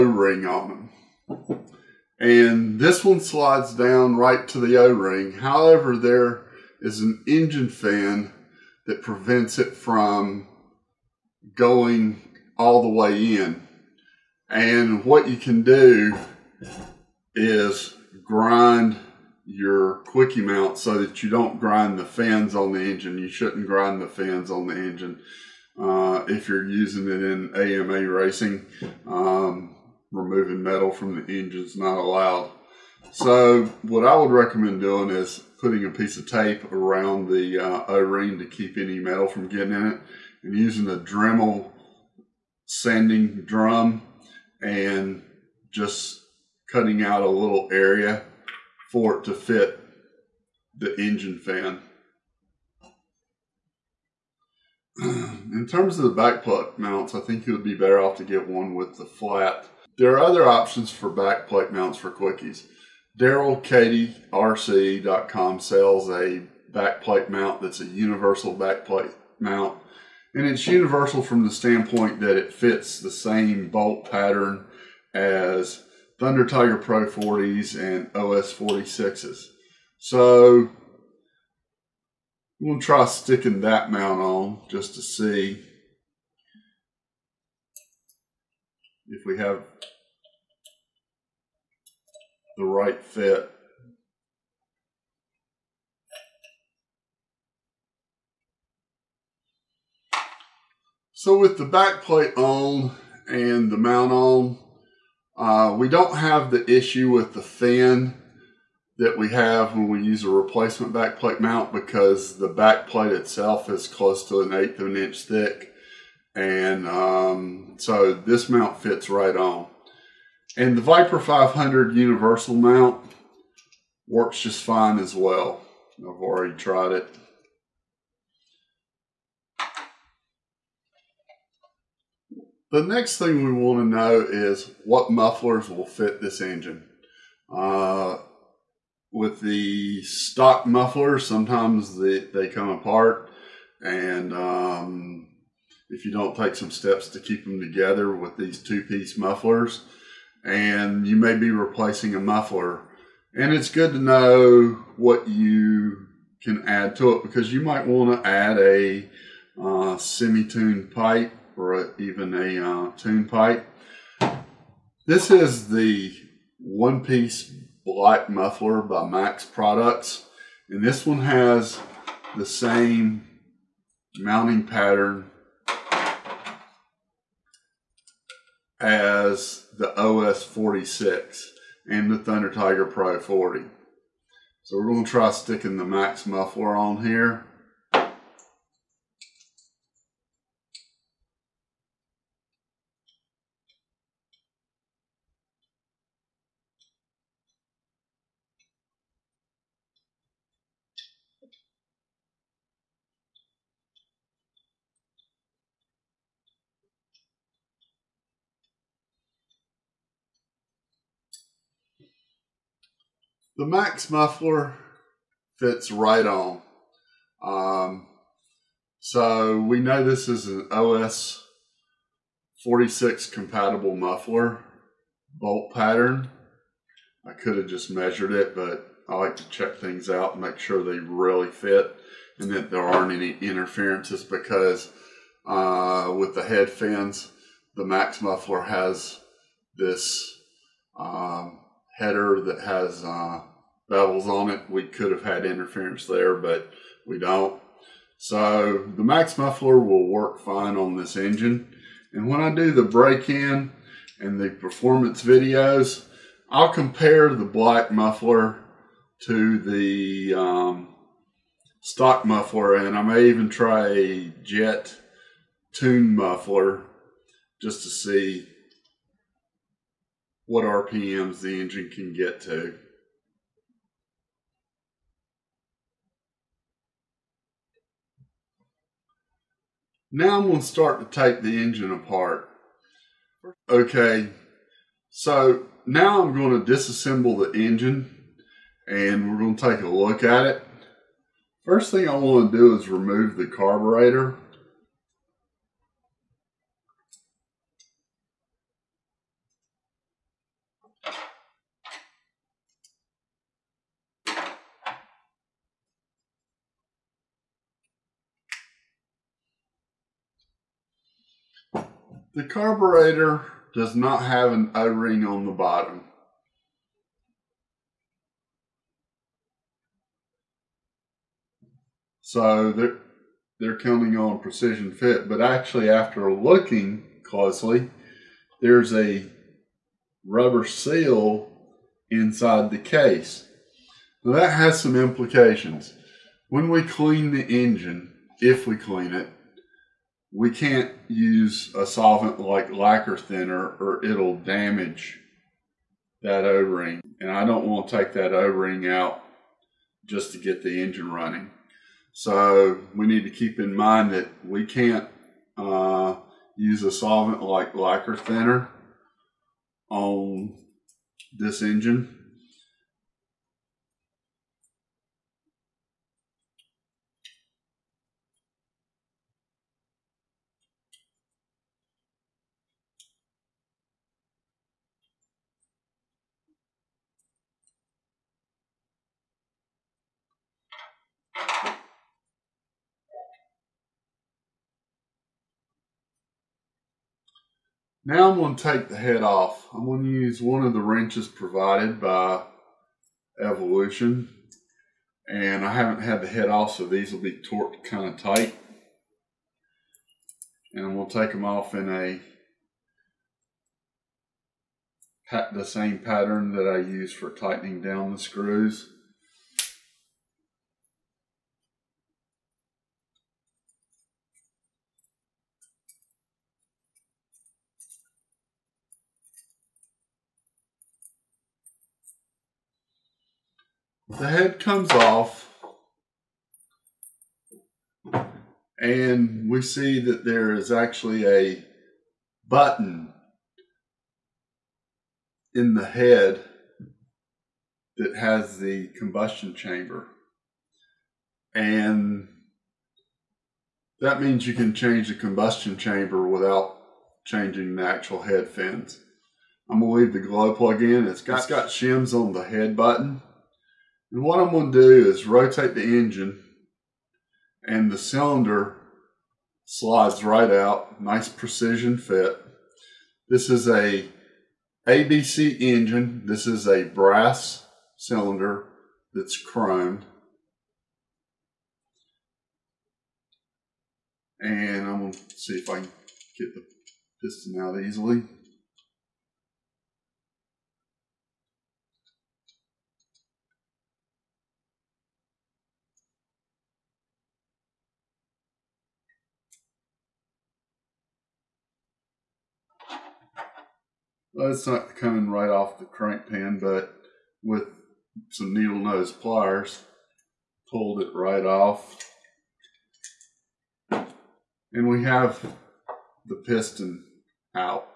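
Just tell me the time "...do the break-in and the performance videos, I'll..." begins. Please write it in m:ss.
4:12.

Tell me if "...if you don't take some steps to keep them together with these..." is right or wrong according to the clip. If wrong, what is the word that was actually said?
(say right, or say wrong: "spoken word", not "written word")
right.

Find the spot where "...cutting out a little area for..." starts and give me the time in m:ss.
0:46.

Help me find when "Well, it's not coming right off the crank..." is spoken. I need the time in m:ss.
8:14.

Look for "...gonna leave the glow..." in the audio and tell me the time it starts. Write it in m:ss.
7:29.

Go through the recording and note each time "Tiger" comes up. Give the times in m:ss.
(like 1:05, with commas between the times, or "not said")
1:16, 3:02.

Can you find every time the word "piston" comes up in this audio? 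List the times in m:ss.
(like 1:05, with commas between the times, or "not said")
7:57, 8:26.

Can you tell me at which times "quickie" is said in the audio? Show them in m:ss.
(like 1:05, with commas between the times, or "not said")
0:20, 1:02.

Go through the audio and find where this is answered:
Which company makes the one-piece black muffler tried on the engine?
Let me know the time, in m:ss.
2:49.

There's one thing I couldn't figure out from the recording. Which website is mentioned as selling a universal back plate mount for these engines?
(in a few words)
RC.com.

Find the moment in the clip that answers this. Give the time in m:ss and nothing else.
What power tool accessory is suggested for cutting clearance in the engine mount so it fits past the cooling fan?
0:40.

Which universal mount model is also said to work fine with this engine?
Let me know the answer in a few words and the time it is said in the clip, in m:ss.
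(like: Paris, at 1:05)
Viper 500, at 2:00.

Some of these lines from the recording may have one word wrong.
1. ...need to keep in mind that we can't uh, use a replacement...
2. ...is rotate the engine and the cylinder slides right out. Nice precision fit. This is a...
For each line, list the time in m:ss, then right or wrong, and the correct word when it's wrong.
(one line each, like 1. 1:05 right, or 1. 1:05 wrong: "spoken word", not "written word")
1. 5:53 wrong: "solvent", not "replacement"
2. 7:35 right.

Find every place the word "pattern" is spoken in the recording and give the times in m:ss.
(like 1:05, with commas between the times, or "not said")
1:14, 2:54, 3:45, 6:45.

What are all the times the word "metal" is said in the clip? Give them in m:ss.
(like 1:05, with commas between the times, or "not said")
0:30, 0:38.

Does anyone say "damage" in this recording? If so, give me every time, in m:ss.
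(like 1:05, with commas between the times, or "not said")
5:44.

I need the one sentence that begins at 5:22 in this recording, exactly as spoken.
So they're, they're counting on precision fit, but actually after looking closely, there's a rubber seal inside the case.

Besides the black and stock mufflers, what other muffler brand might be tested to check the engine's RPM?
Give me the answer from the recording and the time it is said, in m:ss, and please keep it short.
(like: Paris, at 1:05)
Jett, at 4:24.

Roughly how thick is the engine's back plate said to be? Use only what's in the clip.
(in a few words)
an eighth of an inch.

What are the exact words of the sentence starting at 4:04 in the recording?
We could have had interference there, but we don't.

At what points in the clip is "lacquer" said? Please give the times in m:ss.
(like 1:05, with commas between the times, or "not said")
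5:42, 5:57.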